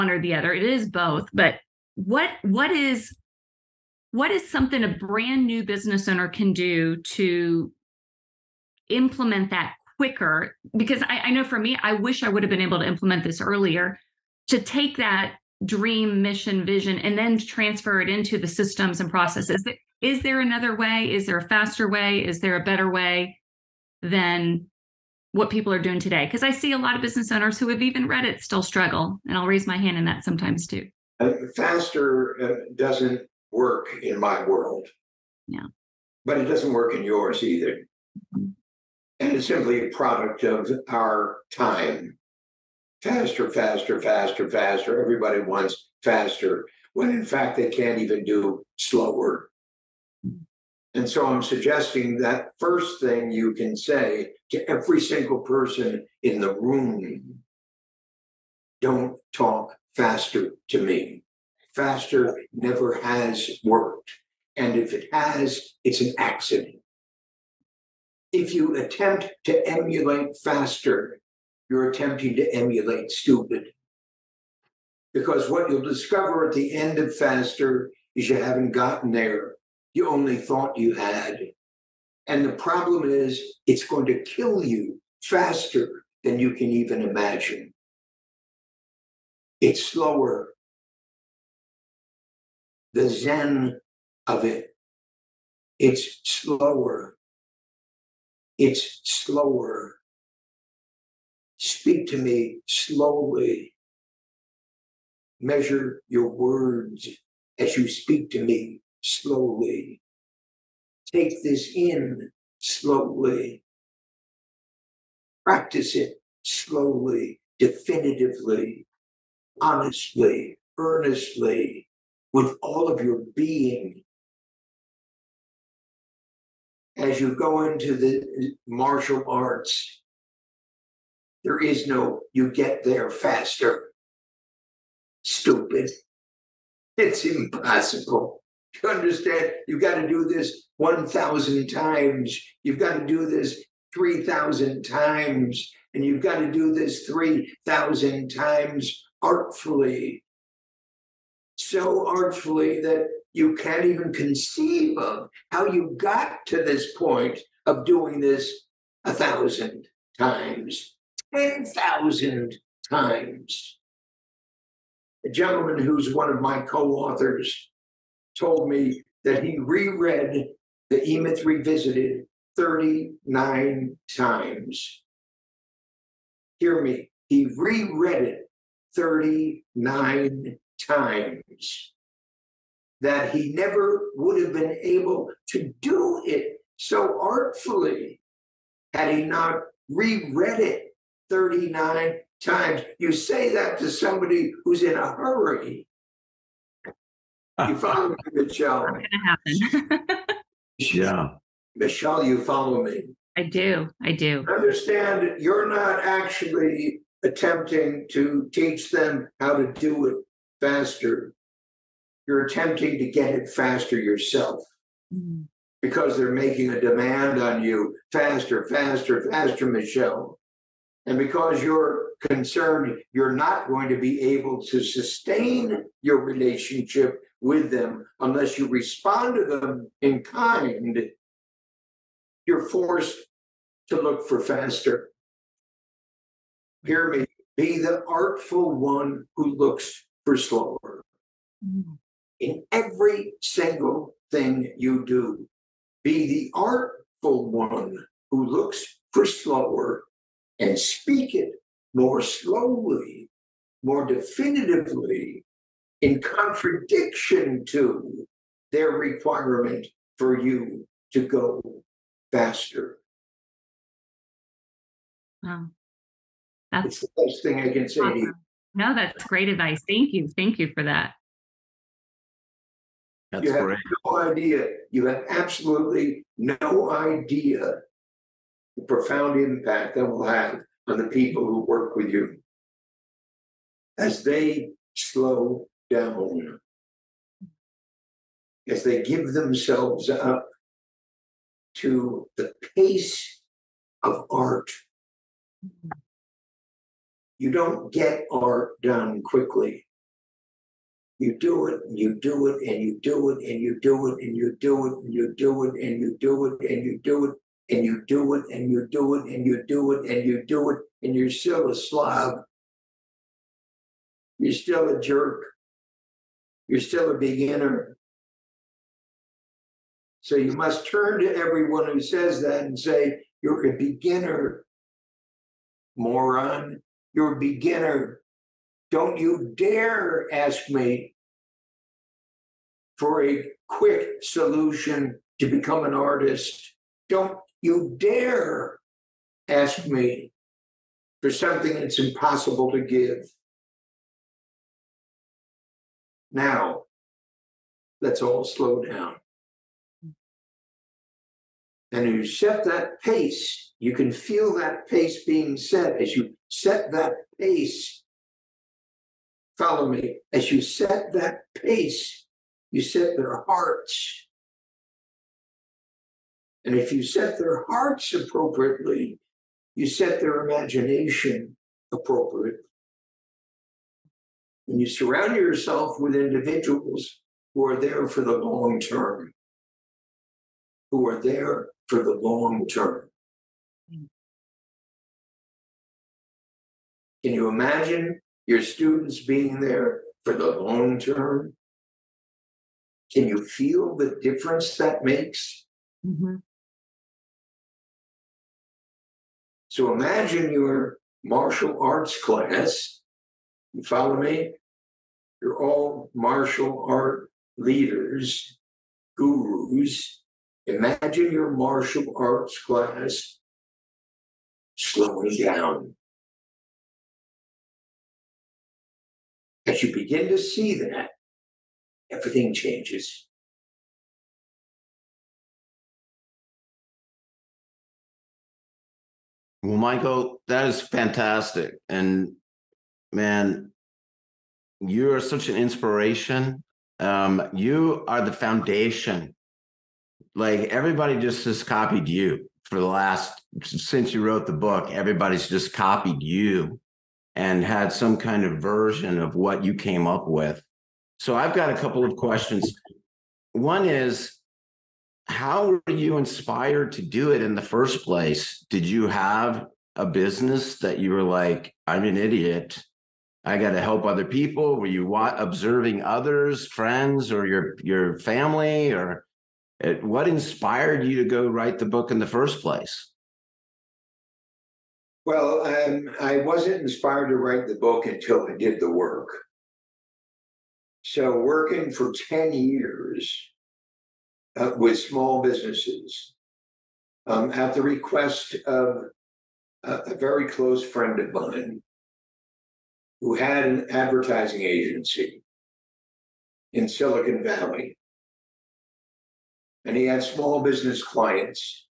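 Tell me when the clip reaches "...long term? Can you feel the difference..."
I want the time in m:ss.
6:30.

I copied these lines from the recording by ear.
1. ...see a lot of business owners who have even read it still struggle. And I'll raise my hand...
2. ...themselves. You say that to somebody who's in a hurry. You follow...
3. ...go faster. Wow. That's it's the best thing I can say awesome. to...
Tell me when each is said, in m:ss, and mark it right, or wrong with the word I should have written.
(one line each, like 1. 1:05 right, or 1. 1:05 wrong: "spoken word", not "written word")
1. 0:26 right
2. 3:12 wrong: "times", not "themselves"
3. 4:21 right.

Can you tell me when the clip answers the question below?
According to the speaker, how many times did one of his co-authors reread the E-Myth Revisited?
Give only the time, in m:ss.
2:58.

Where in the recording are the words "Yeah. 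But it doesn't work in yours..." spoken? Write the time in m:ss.
0:35.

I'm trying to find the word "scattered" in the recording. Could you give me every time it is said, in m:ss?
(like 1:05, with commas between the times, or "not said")
not said.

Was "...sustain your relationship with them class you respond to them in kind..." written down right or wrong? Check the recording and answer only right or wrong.
wrong.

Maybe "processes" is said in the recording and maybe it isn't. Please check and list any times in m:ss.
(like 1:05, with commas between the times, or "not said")
0:19.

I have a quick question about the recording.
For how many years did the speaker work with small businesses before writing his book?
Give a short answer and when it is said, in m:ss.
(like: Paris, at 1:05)
10, at 8:02.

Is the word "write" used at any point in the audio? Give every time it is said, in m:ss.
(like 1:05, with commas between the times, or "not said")
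7:51, 7:57.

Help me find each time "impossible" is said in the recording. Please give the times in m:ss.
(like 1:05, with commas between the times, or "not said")
2:17, 5:41.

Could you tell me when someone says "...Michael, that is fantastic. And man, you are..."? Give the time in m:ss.
7:09.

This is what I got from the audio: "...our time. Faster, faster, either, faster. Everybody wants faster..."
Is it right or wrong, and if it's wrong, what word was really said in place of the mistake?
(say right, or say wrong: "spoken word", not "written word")
wrong: "faster", not "either".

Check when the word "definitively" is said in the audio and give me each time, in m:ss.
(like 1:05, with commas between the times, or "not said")
1:57, 4:14.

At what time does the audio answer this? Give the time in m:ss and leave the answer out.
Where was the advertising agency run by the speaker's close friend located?
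8:16.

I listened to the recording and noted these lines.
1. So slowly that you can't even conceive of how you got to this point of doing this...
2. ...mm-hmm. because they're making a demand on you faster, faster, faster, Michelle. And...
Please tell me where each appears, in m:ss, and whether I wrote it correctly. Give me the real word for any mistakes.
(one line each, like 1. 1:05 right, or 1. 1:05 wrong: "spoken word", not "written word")
1. 2:31 wrong: "artfully", not "slowly"
2. 3:35 right.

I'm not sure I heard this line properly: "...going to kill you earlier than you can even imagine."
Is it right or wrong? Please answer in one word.
wrong.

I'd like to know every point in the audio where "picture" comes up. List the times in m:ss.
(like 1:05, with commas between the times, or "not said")
not said.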